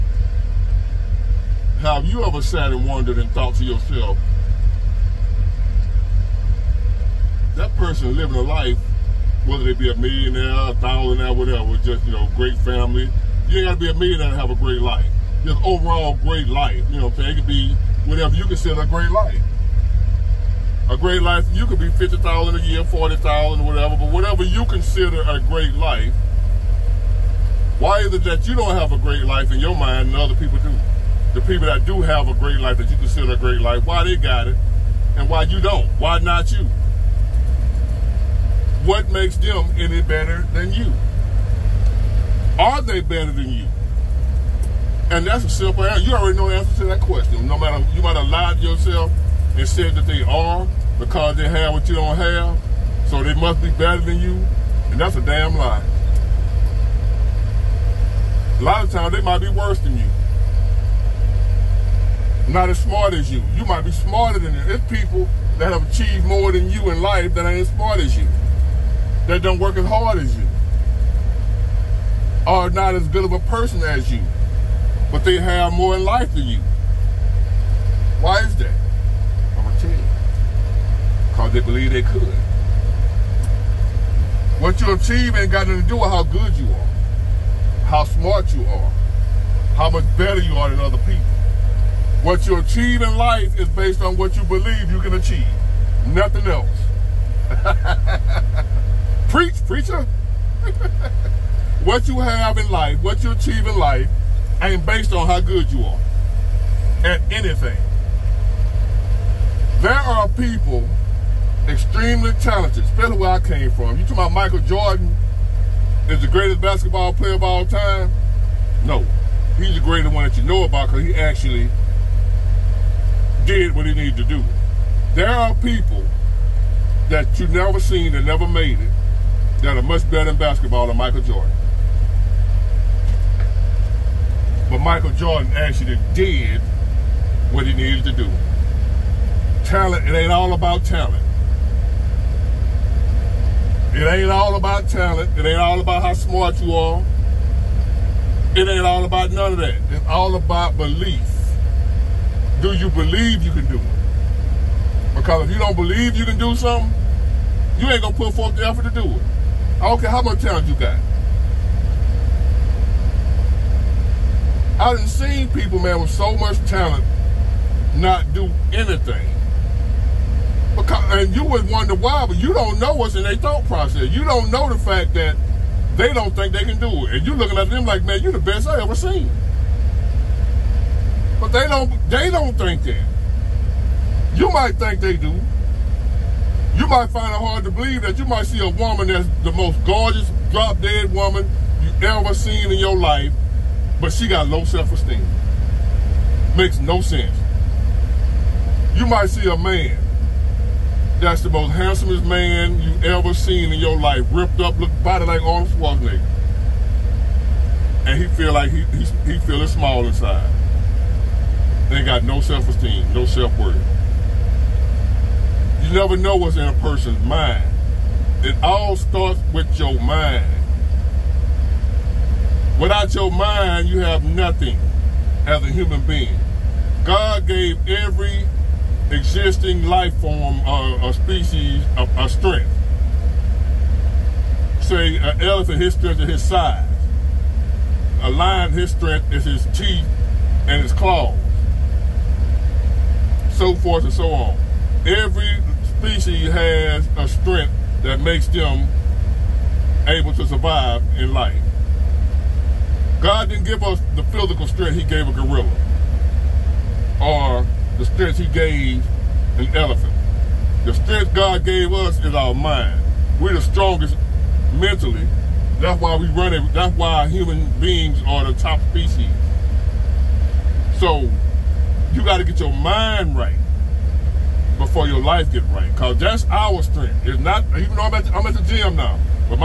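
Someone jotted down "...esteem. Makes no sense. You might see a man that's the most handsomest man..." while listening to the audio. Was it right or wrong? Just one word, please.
right.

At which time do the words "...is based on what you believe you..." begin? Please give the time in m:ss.
1:33.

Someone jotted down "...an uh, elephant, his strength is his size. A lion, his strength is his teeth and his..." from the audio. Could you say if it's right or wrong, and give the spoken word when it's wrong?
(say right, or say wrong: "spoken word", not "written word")
right.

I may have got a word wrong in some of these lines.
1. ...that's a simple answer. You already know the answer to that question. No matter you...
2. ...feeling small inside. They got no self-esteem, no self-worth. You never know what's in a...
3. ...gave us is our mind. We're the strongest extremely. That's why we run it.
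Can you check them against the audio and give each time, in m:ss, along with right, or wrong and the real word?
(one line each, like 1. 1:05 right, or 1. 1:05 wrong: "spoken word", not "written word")
1. 0:45 right
2. 3:29 right
3. 4:21 wrong: "mentally", not "extremely".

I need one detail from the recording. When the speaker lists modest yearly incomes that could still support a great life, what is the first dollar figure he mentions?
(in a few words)
50,000.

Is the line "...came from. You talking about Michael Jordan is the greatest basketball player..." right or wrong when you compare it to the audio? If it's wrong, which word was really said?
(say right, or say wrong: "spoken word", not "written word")
right.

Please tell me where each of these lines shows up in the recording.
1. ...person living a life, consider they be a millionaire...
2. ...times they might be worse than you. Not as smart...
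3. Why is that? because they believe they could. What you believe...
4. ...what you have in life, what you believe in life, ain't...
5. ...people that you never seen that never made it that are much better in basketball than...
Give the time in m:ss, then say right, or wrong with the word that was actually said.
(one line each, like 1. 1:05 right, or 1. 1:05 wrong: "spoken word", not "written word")
1. 0:07 wrong: "whether", not "consider"
2. 0:58 right
3. 1:18 wrong: "achieve", not "believe"
4. 1:41 wrong: "achieve", not "believe"
5. 2:05 right.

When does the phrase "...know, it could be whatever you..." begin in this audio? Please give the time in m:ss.
0:17.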